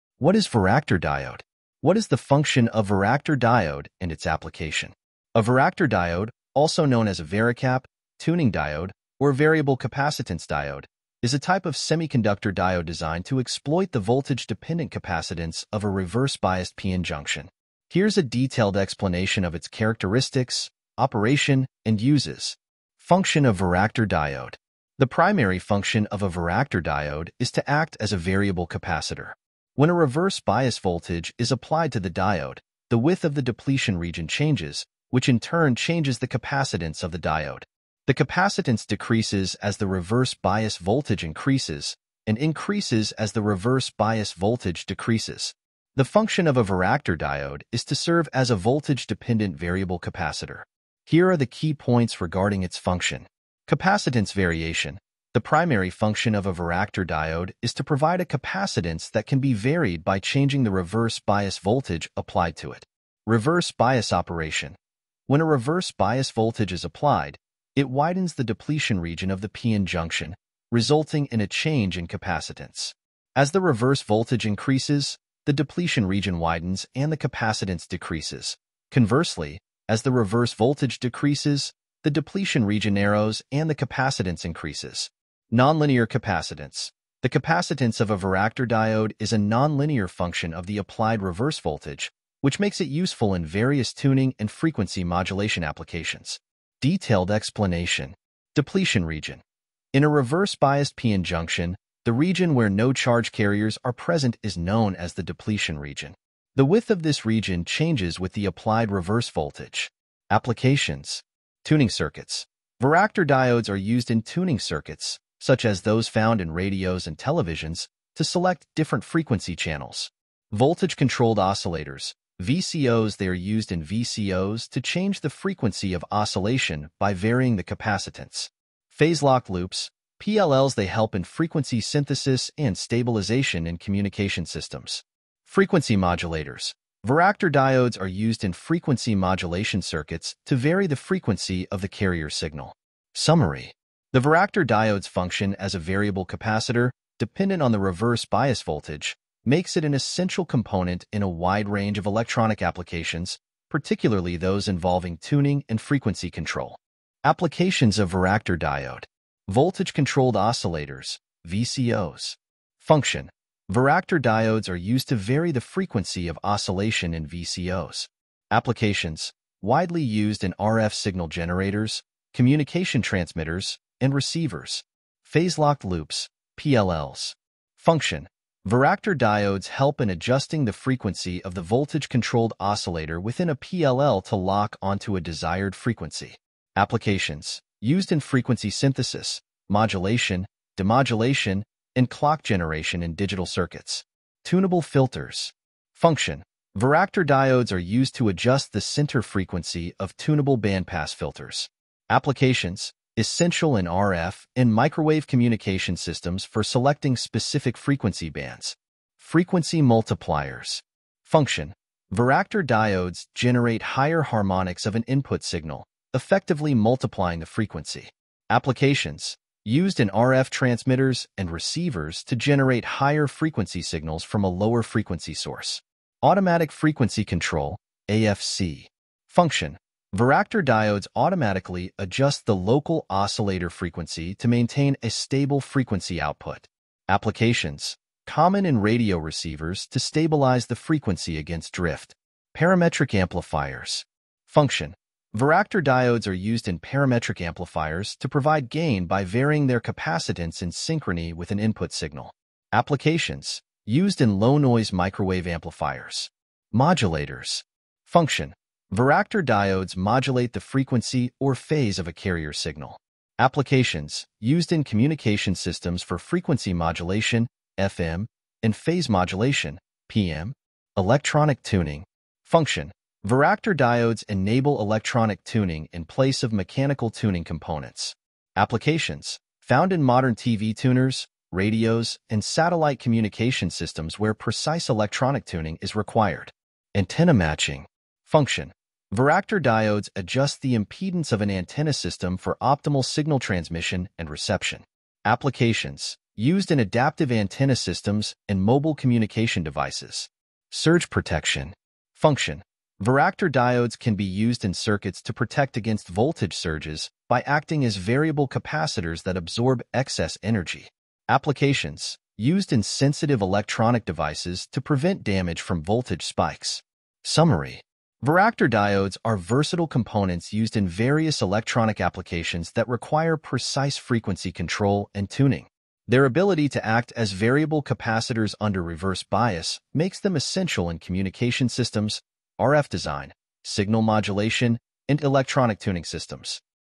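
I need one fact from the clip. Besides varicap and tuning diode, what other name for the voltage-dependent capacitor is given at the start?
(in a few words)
Variable capacitance diode.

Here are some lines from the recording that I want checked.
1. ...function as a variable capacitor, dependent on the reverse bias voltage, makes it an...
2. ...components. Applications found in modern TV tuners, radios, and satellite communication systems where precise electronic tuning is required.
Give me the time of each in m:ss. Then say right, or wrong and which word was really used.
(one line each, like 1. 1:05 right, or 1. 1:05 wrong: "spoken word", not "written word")
1. 2:25 right
2. 4:37 right.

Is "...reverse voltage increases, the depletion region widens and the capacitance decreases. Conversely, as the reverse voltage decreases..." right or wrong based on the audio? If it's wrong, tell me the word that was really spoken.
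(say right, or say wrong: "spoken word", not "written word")
right.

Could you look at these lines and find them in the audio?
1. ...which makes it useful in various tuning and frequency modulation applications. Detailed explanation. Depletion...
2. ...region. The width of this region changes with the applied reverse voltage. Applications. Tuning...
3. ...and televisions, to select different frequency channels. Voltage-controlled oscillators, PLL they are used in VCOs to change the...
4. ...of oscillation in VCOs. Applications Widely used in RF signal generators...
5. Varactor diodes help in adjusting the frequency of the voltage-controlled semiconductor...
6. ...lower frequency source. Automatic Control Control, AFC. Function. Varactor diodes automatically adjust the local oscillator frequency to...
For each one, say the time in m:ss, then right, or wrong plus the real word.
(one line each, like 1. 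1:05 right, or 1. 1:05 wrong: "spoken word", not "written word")
1. 1:32 right
2. 1:45 right
3. 1:57 wrong: "VCOs", not "PLL"
4. 2:46 right
5. 2:58 wrong: "oscillator", not "semiconductor"
6. 3:44 wrong: "Frequency", not "Control".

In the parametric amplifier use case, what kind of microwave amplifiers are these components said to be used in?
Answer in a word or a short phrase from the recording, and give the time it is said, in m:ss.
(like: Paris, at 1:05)
Low-noise microwave amplifiers, at 4:14.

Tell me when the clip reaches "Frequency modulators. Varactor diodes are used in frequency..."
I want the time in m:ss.
2:15.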